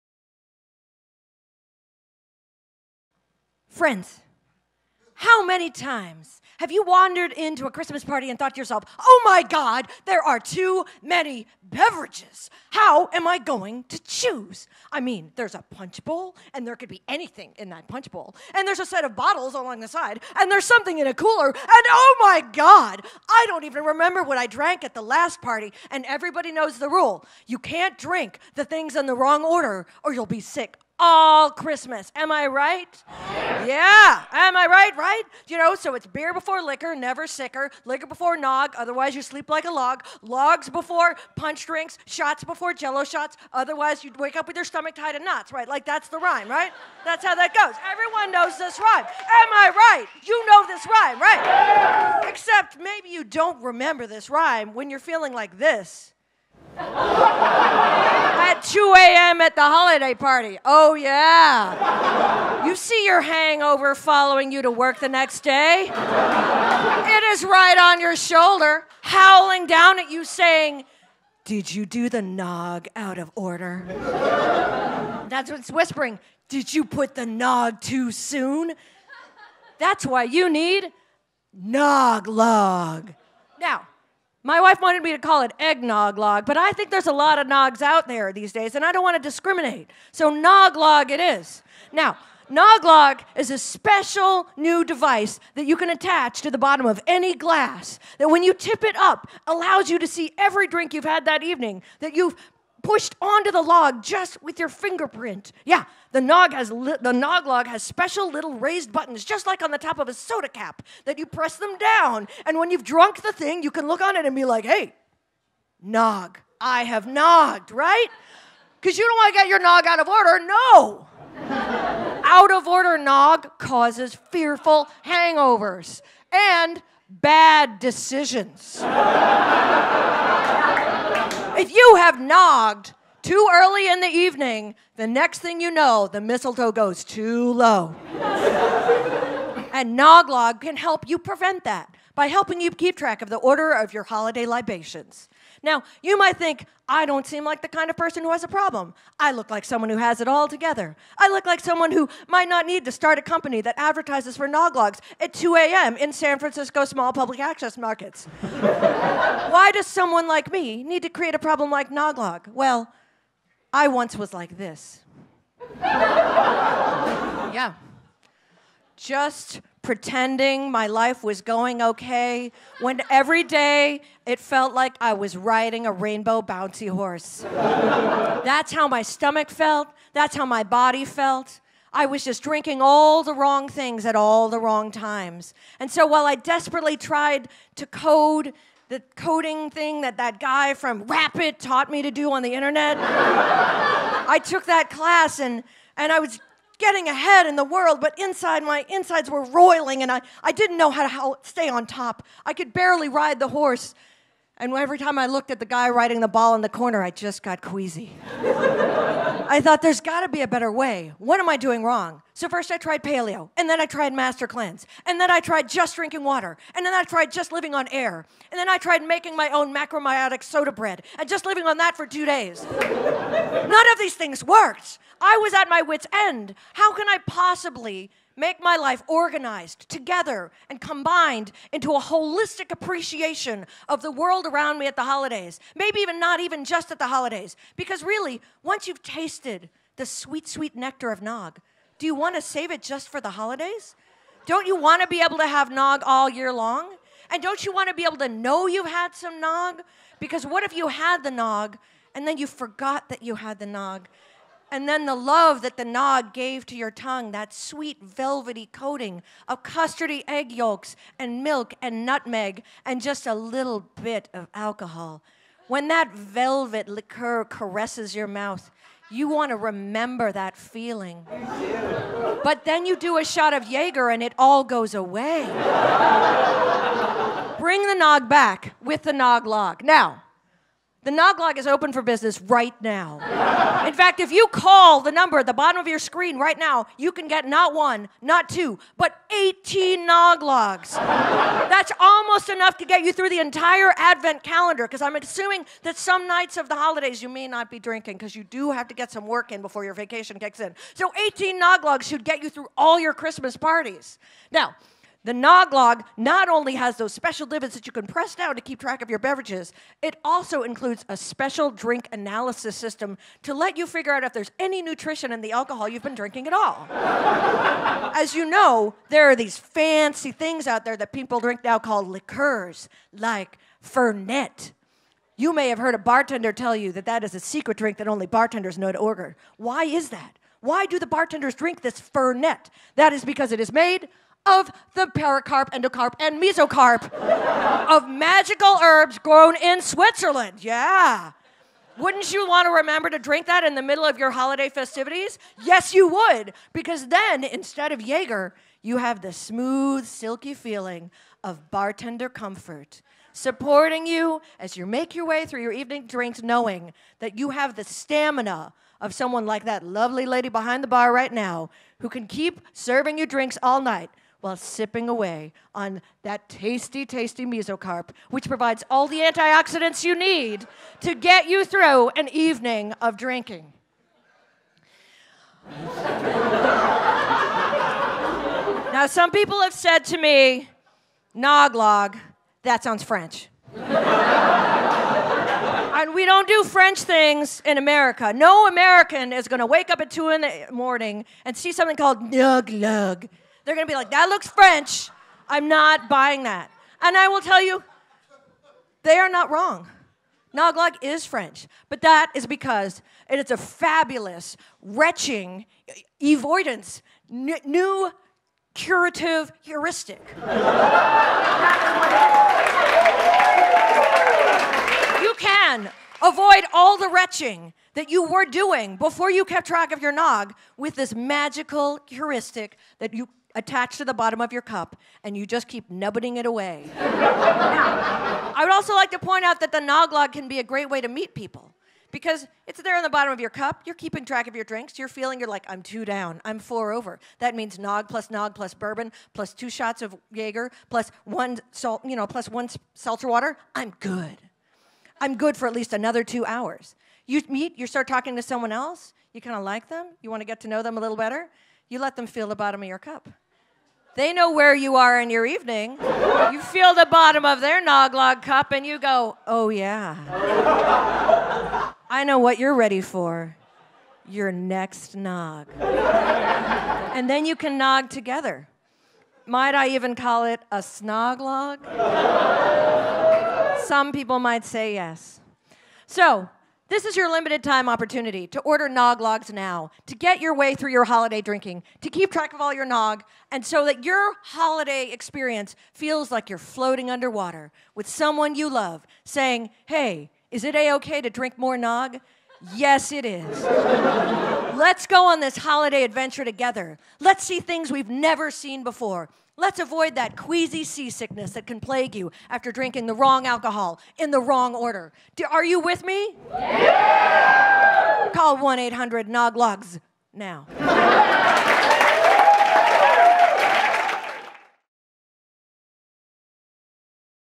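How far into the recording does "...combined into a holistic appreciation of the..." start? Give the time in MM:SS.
03:50.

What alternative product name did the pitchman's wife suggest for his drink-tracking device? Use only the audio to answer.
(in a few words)
Eggnog log.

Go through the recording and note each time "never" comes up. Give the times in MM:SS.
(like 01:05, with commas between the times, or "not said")
00:36, 08:18.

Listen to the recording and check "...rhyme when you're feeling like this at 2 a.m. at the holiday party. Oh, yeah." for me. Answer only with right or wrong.
right.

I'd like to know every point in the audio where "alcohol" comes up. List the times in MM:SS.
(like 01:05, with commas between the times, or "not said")
04:24, 05:15, 08:23.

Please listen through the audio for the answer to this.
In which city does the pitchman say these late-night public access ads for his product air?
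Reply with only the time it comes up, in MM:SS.
02:36.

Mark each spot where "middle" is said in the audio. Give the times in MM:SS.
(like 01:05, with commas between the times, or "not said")
05:43.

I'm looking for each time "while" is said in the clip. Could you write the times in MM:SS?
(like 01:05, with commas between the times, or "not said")
03:06, 06:04.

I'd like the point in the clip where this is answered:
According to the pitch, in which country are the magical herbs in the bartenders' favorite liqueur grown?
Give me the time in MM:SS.
05:39.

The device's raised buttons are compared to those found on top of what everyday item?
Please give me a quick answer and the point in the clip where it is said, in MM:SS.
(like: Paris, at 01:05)
A soda cap, at 01:50.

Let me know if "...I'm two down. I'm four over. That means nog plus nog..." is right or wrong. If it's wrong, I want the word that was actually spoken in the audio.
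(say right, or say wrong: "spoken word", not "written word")
right.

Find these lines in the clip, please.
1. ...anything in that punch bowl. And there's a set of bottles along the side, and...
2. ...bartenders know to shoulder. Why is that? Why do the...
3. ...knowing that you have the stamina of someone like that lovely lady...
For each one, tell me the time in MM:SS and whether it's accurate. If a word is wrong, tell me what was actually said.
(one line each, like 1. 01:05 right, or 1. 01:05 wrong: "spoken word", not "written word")
1. 00:17 right
2. 05:28 wrong: "order", not "shoulder"
3. 05:56 right.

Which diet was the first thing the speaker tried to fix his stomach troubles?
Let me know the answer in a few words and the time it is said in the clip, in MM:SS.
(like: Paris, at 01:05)
Paleo, at 03:33.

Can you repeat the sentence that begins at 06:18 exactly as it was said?
now, some people have said to me, Noglog, that sounds French.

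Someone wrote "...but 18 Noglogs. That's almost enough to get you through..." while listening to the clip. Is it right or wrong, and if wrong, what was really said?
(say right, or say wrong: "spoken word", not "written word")
right.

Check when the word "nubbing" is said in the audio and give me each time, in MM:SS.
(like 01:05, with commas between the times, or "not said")
07:05.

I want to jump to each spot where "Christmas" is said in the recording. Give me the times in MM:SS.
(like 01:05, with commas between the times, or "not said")
00:07, 00:31, 05:03.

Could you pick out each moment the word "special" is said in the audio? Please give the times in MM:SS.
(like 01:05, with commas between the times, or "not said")
01:33, 01:47, 05:07, 05:11.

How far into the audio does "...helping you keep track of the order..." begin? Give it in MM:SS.
02:22.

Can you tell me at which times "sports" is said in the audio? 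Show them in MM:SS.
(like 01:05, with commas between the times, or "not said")
not said.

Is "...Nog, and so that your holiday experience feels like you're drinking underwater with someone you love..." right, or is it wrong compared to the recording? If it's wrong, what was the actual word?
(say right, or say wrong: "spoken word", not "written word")
wrong: "floating", not "drinking".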